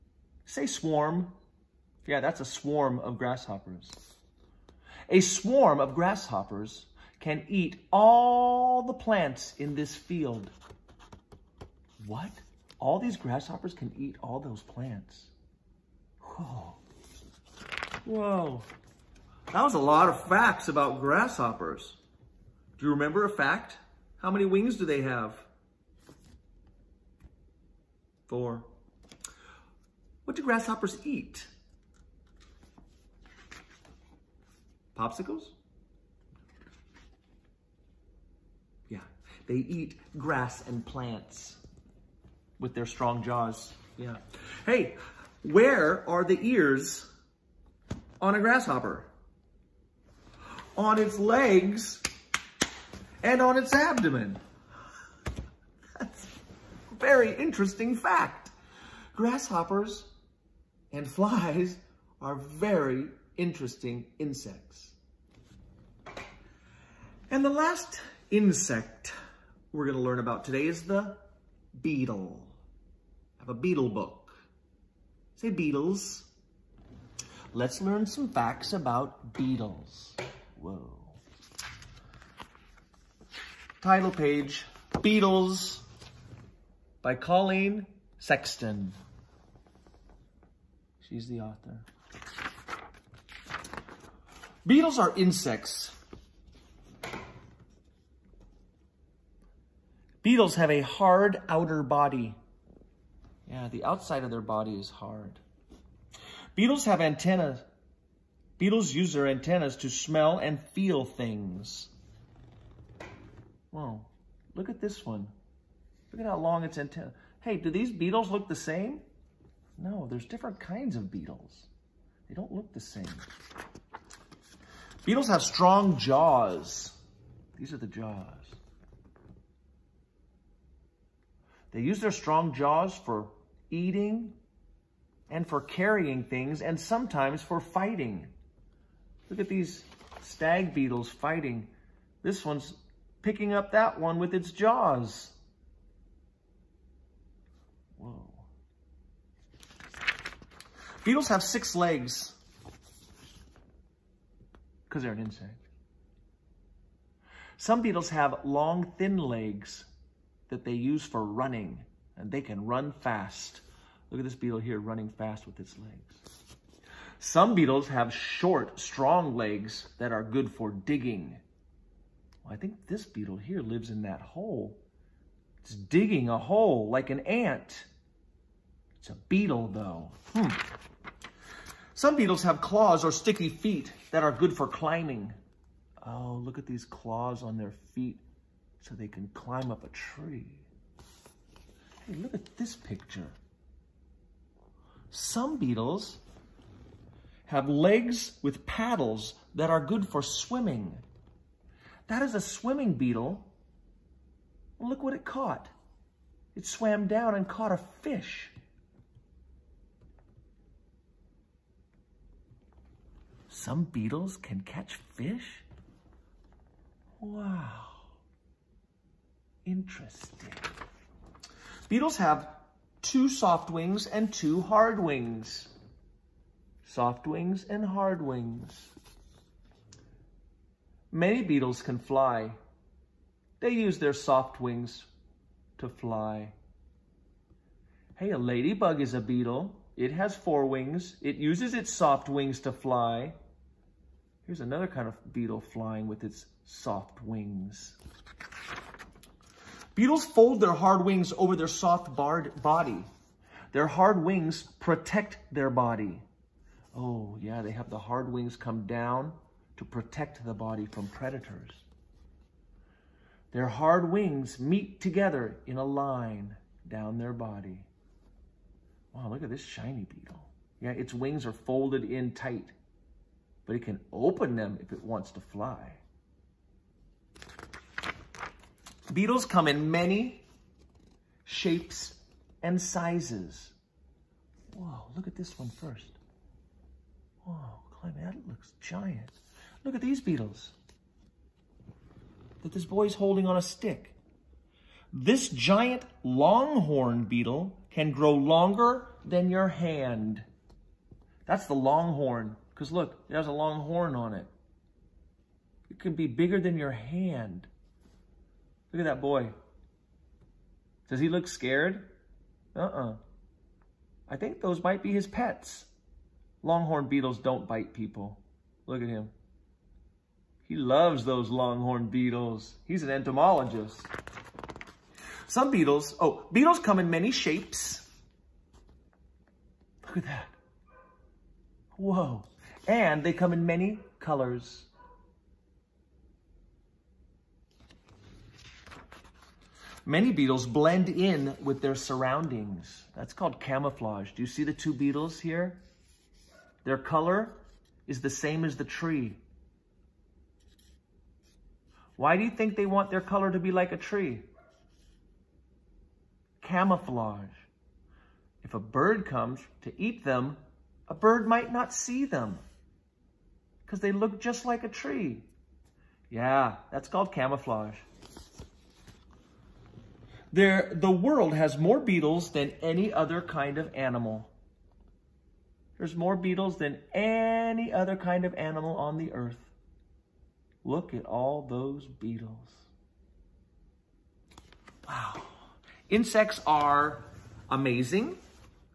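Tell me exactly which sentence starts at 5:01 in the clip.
That's the longhorn, because look, it has a long horn on it.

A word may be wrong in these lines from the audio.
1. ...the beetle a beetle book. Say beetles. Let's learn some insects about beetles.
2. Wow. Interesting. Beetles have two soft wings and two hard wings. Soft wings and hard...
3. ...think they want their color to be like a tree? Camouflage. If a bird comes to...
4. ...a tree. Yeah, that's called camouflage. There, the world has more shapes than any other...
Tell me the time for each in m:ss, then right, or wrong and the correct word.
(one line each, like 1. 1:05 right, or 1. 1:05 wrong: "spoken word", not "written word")
1. 1:10 wrong: "facts", not "insects"
2. 3:37 right
3. 5:52 right
4. 6:04 wrong: "beetles", not "shapes".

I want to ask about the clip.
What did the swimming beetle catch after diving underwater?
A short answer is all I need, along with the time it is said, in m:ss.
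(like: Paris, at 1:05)
A fish, at 3:27.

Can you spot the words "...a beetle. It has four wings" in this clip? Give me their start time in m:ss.
3:59.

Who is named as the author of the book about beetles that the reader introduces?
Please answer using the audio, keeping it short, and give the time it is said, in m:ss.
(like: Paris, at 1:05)
Colleen Sexton, at 1:27.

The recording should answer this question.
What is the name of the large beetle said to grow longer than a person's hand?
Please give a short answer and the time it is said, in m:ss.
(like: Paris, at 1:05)
Giant longhorn beetle, at 4:55.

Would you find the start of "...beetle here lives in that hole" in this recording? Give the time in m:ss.
2:53.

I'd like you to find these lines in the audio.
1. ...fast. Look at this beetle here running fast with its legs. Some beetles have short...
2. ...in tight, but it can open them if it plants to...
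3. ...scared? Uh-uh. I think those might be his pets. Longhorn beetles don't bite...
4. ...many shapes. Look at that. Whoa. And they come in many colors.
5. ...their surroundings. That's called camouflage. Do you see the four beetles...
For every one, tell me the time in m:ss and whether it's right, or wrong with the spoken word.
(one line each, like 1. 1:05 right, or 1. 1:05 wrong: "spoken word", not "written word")
1. 2:43 right
2. 4:32 wrong: "wants", not "plants"
3. 5:11 right
4. 5:27 right
5. 5:41 wrong: "two", not "four".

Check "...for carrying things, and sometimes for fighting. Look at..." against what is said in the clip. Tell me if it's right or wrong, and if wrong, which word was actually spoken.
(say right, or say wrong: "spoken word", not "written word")
right.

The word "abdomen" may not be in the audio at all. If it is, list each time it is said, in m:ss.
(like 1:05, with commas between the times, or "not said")
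0:53.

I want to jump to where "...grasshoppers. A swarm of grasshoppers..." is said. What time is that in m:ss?
0:03.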